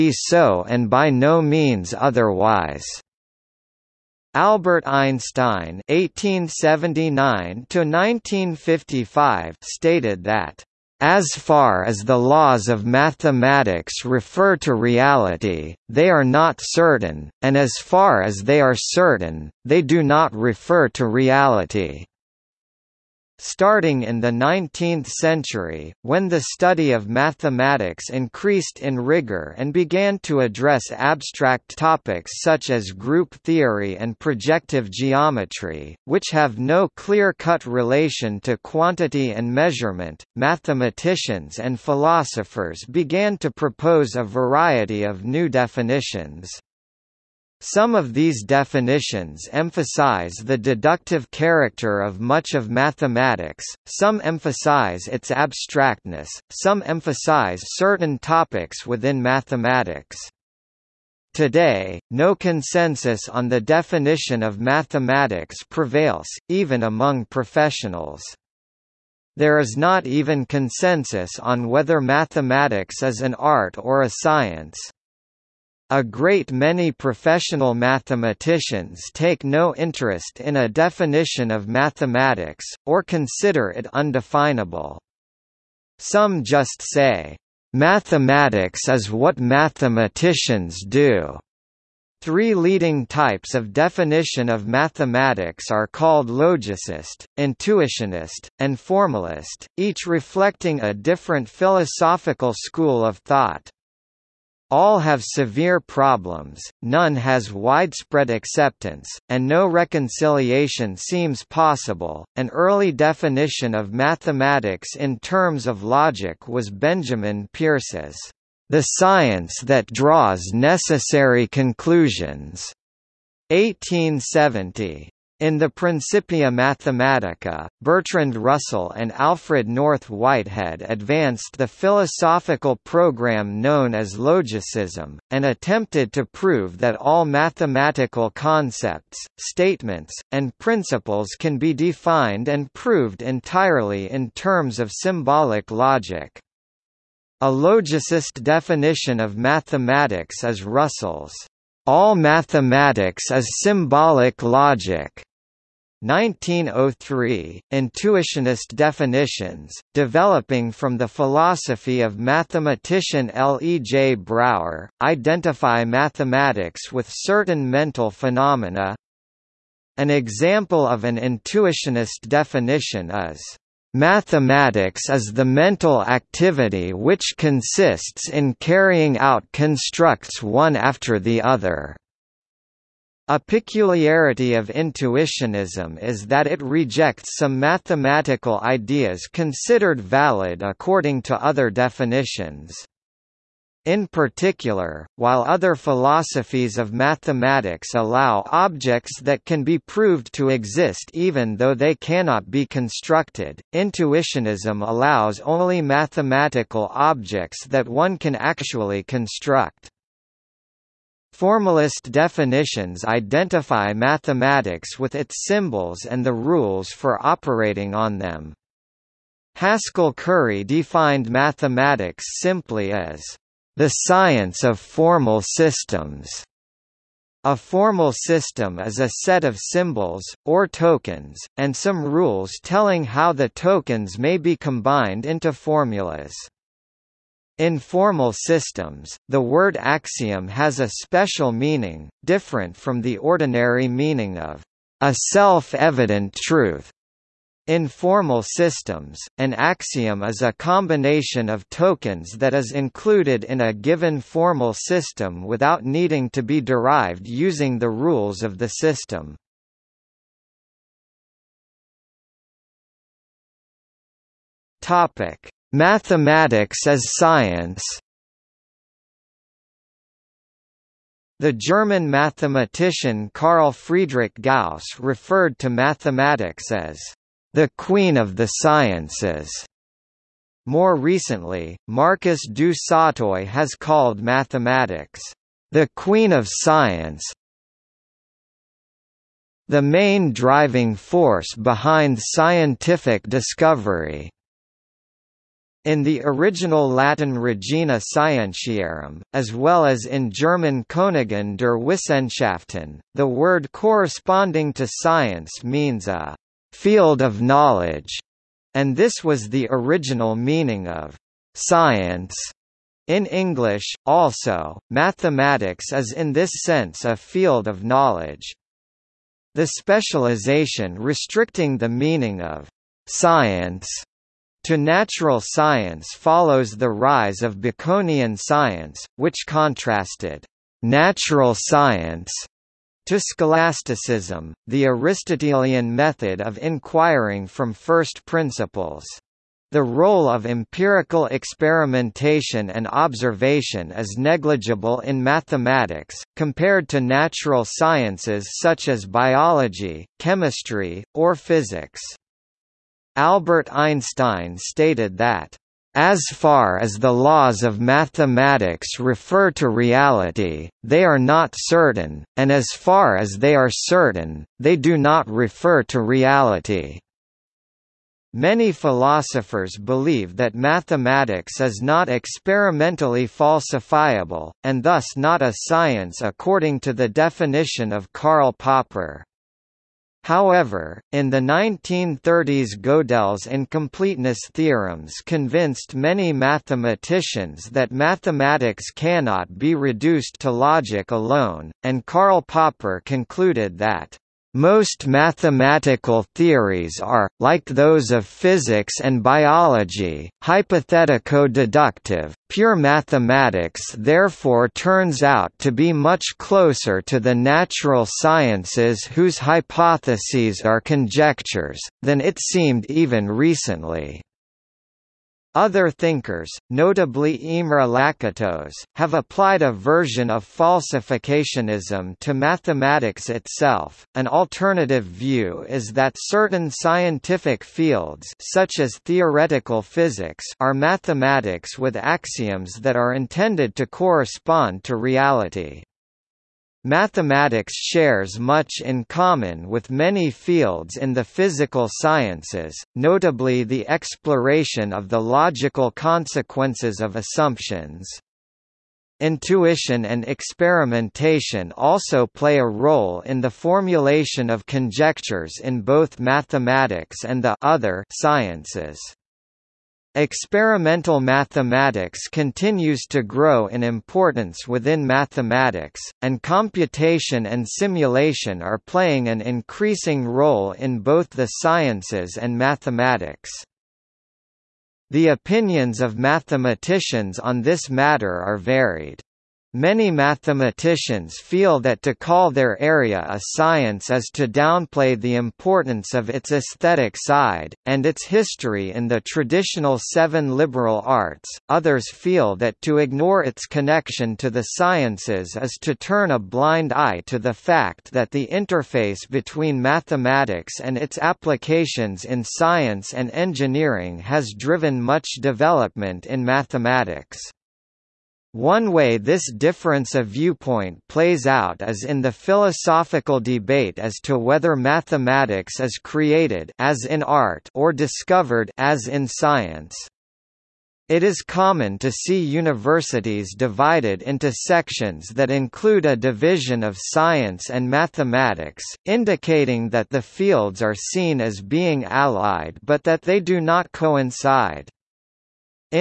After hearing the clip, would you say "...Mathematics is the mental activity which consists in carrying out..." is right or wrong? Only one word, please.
right.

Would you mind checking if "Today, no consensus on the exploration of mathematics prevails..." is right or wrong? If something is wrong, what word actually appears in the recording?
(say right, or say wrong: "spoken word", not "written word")
wrong: "definition", not "exploration".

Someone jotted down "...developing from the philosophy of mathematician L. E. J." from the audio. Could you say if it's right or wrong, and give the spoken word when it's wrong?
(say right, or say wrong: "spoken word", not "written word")
right.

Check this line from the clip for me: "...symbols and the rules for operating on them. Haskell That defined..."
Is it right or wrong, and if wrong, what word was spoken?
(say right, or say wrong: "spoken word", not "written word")
wrong: "Curry", not "That".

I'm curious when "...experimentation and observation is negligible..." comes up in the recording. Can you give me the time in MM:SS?
05:41.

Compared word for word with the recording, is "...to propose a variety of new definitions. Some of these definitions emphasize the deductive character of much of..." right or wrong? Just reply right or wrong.
right.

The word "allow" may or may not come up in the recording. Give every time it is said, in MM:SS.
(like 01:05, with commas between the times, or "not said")
03:17, 03:24.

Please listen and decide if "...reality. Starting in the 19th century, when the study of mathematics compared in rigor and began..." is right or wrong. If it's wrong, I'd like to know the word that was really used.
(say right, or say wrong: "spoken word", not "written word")
wrong: "increased", not "compared".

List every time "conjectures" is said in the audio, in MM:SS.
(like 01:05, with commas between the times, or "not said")
06:50, 07:34.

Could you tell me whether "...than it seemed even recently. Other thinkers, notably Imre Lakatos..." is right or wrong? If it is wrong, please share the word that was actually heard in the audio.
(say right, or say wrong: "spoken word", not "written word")
right.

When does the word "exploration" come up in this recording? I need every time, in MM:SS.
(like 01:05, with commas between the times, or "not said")
07:23.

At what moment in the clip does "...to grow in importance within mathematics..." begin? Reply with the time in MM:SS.
07:43.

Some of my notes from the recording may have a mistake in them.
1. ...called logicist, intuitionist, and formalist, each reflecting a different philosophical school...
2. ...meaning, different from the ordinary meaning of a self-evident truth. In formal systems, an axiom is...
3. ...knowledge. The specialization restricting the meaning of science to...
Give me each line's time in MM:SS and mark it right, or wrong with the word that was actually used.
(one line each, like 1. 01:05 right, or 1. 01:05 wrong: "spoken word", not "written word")
1. 01:35 right
2. 04:01 right
3. 05:17 right.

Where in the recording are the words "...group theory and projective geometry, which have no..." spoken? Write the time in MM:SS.
00:32.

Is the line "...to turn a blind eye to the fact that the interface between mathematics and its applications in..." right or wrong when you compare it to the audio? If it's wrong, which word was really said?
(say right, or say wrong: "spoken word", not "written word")
right.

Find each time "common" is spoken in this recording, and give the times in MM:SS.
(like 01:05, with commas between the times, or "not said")
07:19, 08:41.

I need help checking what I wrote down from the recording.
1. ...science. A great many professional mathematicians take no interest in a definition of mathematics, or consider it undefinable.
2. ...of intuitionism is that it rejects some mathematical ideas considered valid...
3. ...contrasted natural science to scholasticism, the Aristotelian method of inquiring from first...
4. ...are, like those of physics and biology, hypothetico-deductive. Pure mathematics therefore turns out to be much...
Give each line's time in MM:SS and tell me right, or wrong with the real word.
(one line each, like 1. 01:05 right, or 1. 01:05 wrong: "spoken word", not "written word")
1. 01:14 right
2. 03:04 right
3. 05:29 right
4. 06:37 right.